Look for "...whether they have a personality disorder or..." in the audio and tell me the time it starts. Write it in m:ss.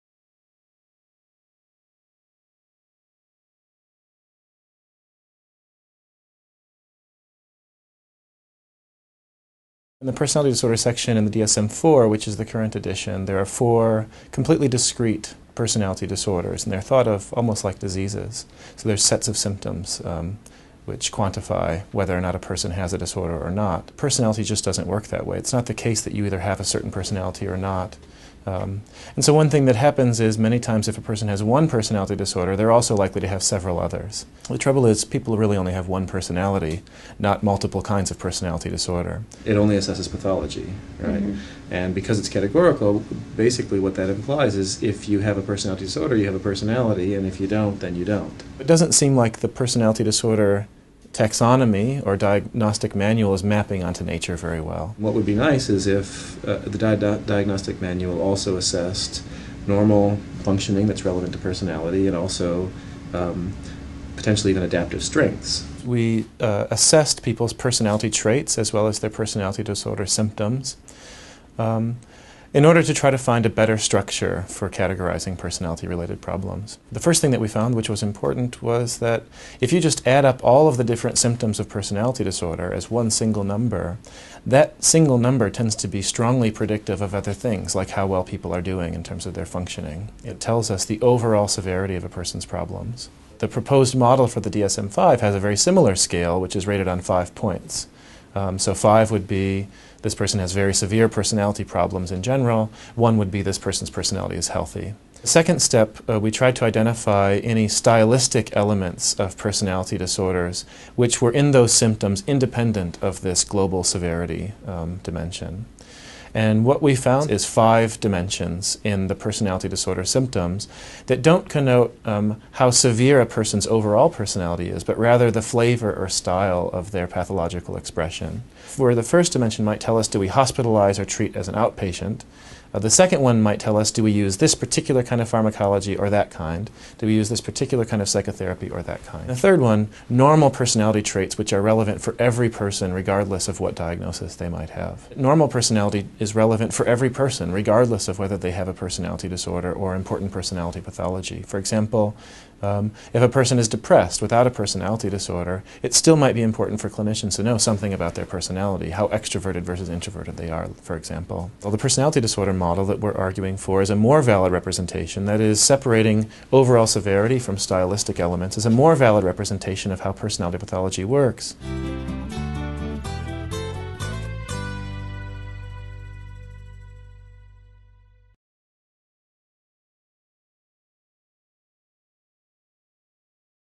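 2:28.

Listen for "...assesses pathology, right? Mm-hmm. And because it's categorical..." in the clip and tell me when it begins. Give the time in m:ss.
0:39.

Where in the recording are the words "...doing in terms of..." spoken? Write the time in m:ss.
1:28.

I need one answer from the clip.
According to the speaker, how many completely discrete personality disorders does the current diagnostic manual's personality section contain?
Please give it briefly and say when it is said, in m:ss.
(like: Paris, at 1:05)
4, at 0:13.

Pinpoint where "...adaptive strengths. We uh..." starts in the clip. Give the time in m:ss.
1:04.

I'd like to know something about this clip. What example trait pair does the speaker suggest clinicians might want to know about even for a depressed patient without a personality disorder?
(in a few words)
extroverted versus introverted.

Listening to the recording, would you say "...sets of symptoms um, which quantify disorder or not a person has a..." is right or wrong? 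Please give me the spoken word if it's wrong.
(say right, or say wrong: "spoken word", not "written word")
wrong: "whether", not "disorder".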